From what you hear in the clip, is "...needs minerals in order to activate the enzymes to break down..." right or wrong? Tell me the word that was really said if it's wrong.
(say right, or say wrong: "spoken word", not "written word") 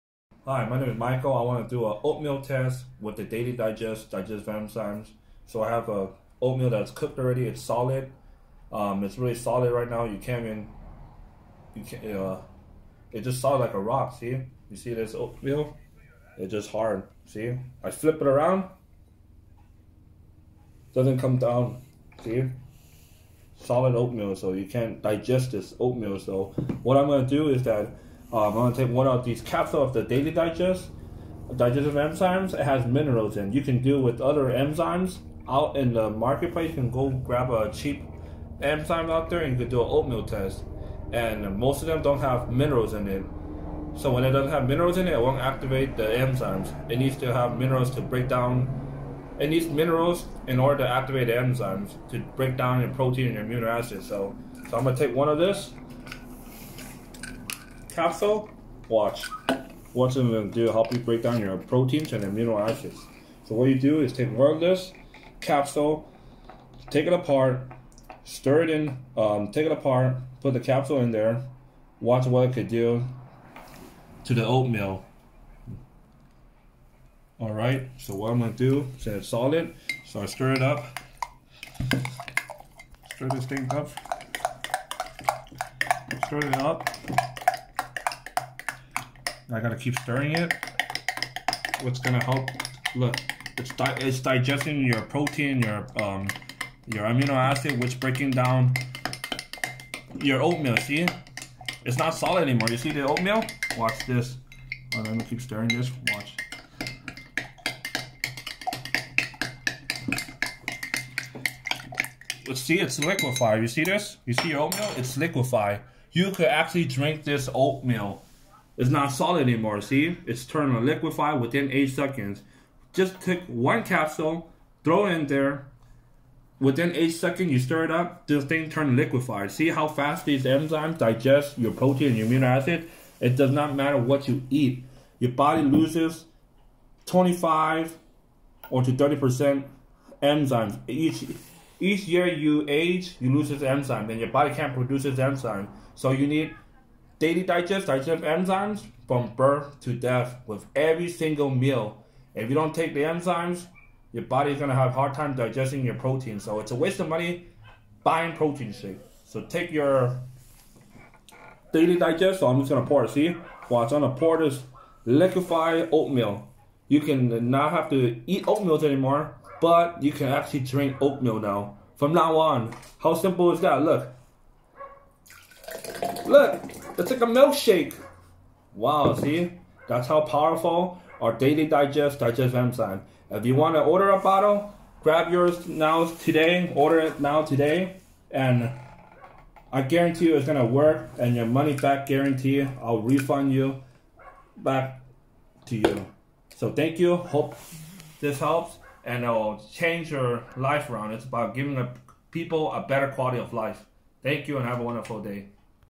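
right.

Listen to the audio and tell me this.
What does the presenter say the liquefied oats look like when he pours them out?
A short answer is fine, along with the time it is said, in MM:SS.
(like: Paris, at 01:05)
a milkshake, at 02:57.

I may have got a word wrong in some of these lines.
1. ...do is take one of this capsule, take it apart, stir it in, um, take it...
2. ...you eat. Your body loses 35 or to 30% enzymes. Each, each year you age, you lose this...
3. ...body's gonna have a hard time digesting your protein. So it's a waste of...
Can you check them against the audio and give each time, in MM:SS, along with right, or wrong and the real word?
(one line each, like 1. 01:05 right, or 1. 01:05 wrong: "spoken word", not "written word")
1. 01:03 right
2. 02:14 wrong: "25", not "35"
3. 02:34 right.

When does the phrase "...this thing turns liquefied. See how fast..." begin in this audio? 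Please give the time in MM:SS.
02:08.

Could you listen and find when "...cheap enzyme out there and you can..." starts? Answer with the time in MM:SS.
00:37.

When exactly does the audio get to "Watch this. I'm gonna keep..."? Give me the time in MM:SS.
01:43.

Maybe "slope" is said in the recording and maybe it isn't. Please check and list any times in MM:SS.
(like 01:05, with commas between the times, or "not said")
not said.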